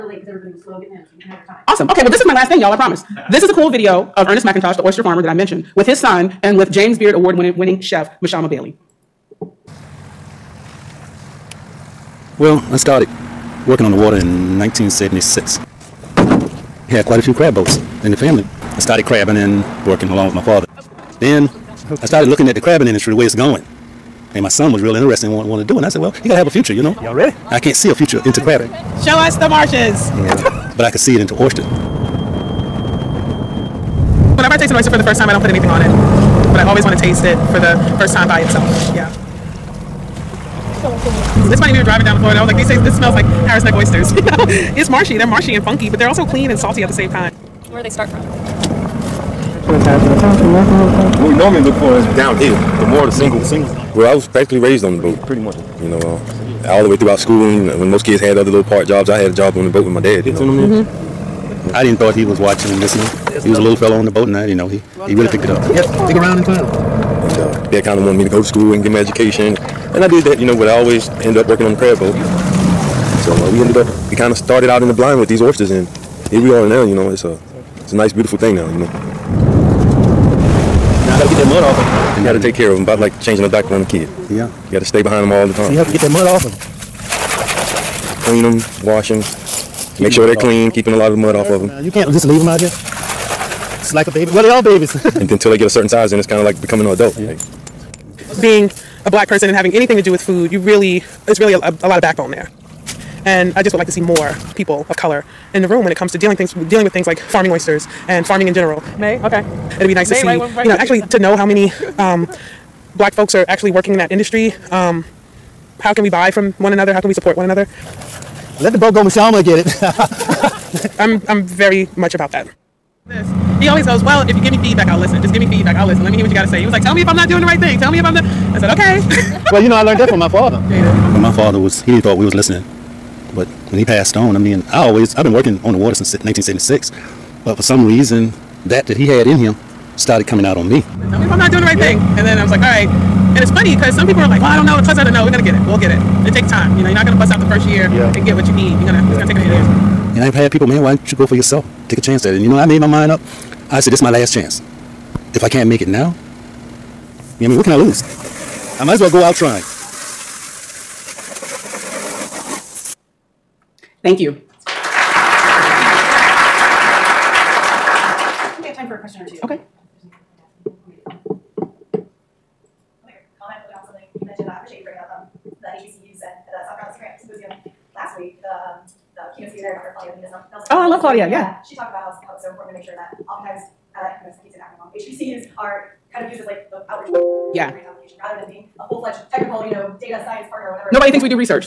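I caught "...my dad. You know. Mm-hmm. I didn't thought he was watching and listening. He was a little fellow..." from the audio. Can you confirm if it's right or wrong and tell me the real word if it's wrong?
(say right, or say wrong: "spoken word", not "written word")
right.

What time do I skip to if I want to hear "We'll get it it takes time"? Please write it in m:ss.
2:25.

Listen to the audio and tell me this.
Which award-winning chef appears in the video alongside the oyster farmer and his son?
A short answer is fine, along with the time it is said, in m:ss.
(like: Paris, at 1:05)
Mashama Bailey, at 0:08.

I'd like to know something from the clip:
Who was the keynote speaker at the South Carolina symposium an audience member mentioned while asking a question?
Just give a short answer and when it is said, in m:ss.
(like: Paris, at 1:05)
Dr. Claudia Nelson, at 2:59.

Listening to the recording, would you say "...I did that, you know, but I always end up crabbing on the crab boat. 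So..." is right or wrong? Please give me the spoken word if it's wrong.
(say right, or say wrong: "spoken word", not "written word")
wrong: "working", not "crabbing".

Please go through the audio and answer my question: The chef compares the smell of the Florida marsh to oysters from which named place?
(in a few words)
Harris Neck.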